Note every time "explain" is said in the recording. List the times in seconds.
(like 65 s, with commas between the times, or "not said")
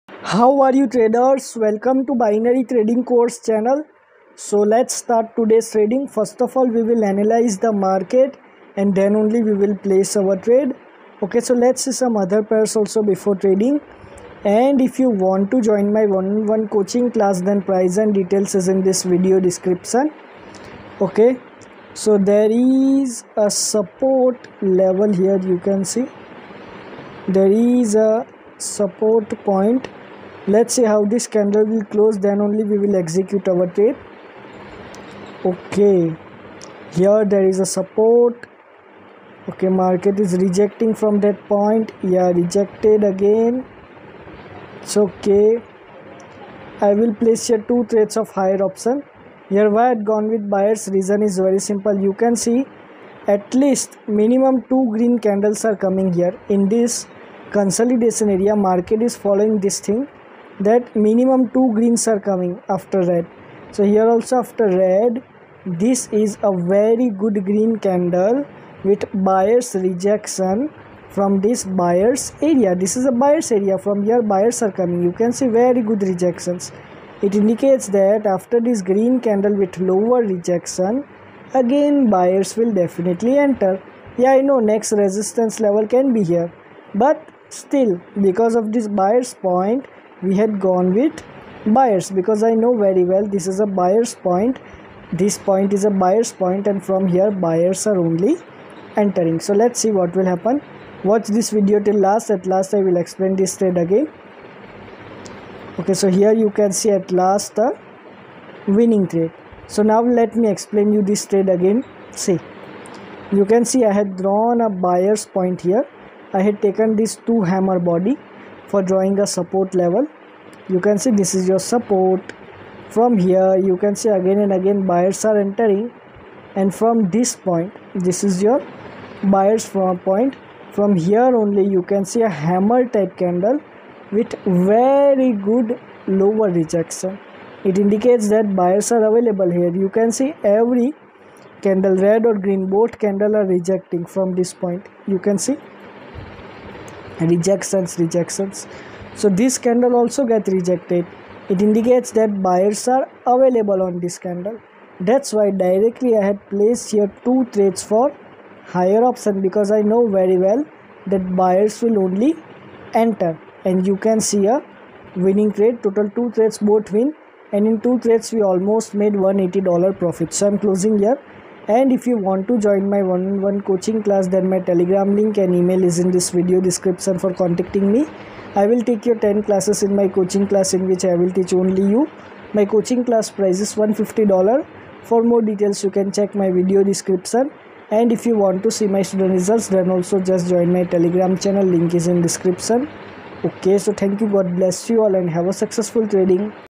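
102 s, 110 s.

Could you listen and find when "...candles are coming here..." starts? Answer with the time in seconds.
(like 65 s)
55 s.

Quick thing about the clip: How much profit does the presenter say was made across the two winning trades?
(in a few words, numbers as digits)
180 dollars.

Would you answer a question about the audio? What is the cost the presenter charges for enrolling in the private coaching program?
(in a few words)
$150.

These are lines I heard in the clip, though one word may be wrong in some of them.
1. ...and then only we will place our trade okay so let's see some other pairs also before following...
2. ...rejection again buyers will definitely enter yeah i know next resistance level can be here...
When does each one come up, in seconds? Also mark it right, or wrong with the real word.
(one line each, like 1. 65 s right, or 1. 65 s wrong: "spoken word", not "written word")
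1. 8 s wrong: "trading", not "following"
2. 80 s right.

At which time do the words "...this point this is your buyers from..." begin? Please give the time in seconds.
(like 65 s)
127 s.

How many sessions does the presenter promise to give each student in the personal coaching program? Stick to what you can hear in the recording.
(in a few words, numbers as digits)
10.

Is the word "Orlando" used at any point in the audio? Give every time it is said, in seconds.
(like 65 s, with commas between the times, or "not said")
not said.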